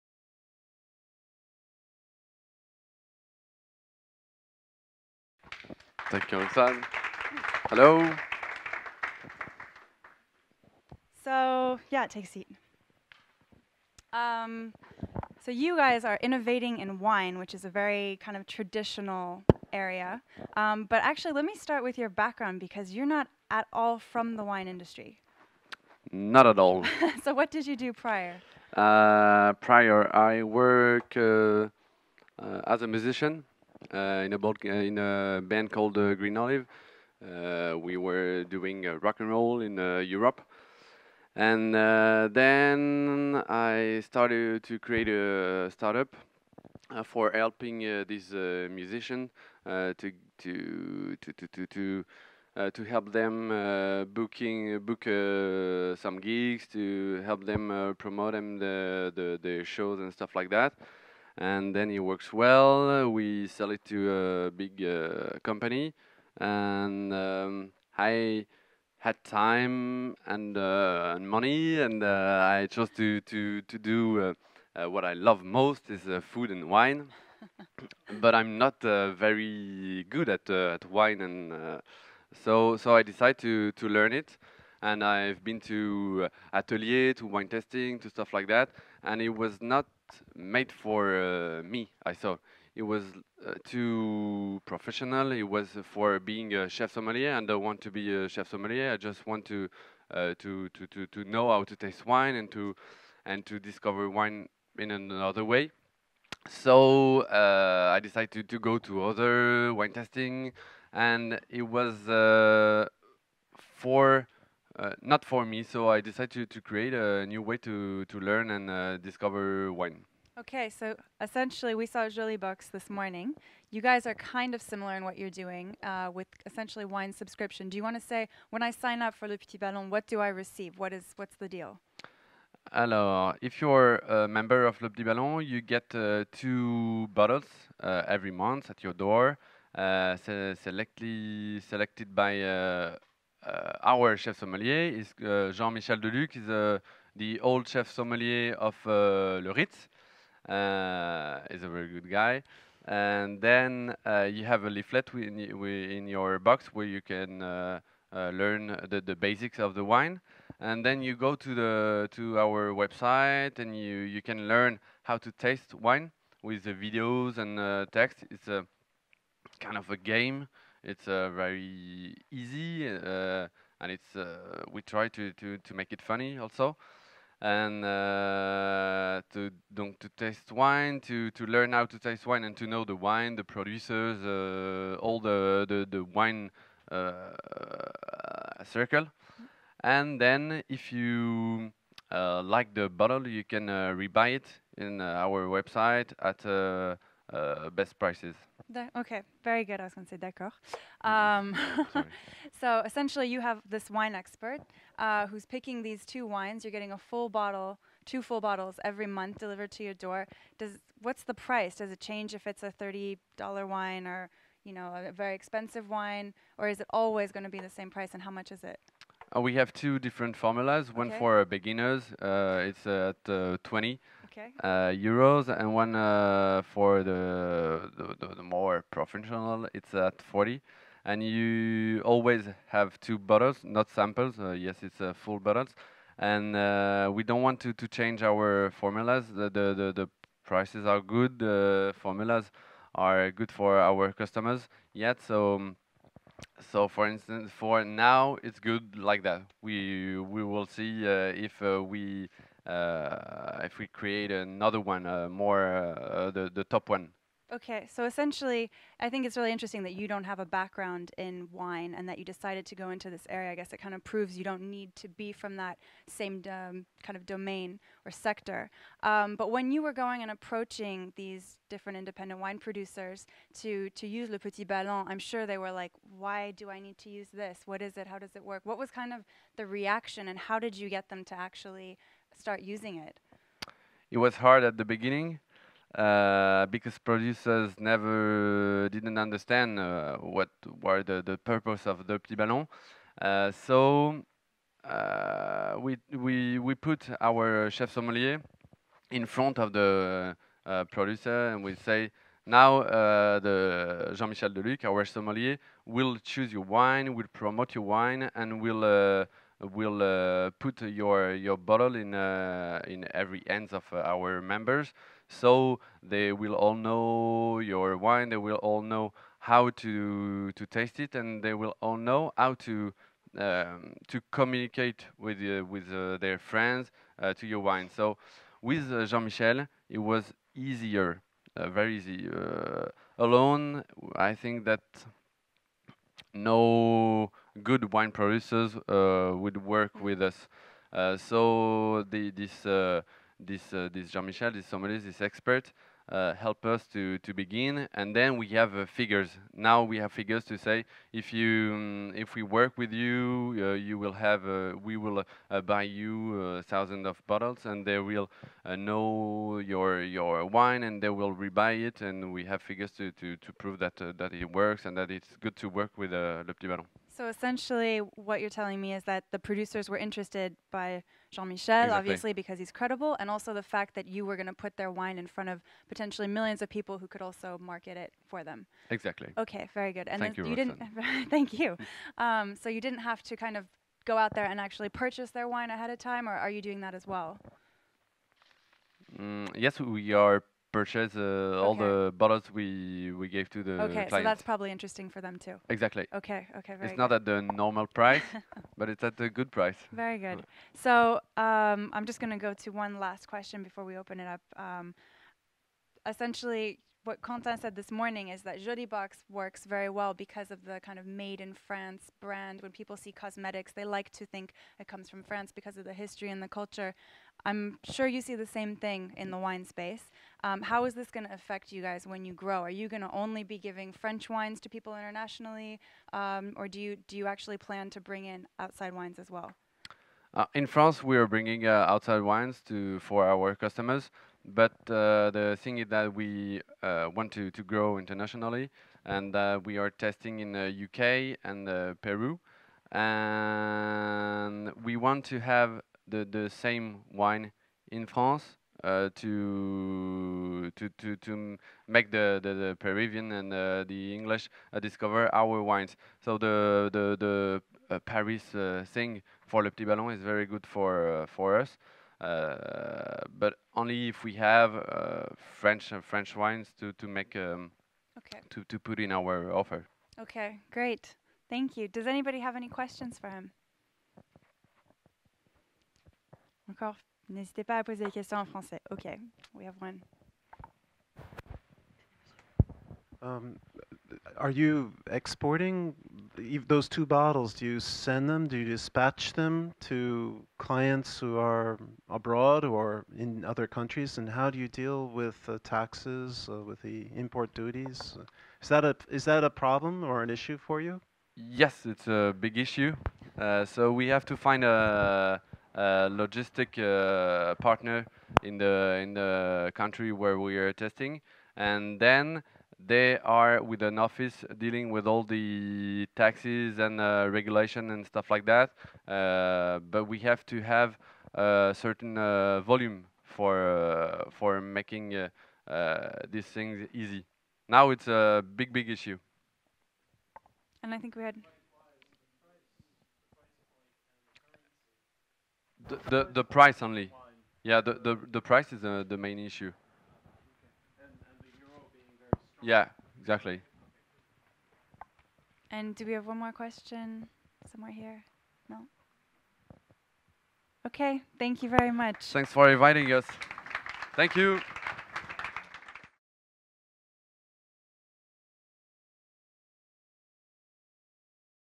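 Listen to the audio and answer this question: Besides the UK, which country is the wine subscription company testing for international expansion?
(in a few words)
Peru.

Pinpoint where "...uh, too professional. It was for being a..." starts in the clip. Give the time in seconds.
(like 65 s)
93 s.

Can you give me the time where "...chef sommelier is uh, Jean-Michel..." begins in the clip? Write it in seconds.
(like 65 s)
144 s.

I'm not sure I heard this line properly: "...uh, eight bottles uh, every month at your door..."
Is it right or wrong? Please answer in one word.
wrong.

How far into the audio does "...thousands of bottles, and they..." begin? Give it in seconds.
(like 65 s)
356 s.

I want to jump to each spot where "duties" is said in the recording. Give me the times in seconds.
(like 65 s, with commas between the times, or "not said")
497 s.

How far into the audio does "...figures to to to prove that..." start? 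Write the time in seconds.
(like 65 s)
362 s.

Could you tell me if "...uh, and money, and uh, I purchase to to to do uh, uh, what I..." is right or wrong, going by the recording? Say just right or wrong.
wrong.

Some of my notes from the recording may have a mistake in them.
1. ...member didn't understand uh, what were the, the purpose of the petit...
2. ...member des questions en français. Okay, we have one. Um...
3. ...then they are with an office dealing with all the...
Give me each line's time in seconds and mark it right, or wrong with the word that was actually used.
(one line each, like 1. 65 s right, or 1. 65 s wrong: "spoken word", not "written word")
1. 287 s wrong: "never", not "member"
2. 477 s wrong: "poser", not "member"
3. 511 s right.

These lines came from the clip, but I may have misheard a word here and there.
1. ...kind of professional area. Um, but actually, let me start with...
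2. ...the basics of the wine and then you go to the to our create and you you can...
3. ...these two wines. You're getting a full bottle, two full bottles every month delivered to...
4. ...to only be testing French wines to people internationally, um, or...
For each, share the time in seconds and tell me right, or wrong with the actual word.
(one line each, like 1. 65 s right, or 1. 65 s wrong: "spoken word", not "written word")
1. 18 s wrong: "traditional", not "professional"
2. 159 s wrong: "website", not "create"
3. 205 s right
4. 423 s wrong: "giving", not "testing".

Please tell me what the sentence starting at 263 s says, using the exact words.
I guess it kind of proves you don't need to be from that same um, kind of domain or sector.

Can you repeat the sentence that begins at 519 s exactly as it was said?
Uh, but we have to have a certain uh, volume for uh, for making uh, uh, these things easy.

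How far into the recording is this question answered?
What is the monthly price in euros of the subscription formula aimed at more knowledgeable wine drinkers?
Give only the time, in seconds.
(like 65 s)
230 s.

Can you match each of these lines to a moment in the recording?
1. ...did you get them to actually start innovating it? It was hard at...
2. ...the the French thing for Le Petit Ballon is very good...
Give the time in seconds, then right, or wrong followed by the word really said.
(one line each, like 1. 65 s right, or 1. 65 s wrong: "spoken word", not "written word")
1. 280 s wrong: "using", not "innovating"
2. 456 s wrong: "Paris", not "French".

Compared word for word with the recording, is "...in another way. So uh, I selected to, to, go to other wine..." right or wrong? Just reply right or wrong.
wrong.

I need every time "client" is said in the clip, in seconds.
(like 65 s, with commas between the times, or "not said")
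394 s, 490 s.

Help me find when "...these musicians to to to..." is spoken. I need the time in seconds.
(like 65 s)
48 s.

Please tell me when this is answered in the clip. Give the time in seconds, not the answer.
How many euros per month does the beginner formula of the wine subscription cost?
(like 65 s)
223 s.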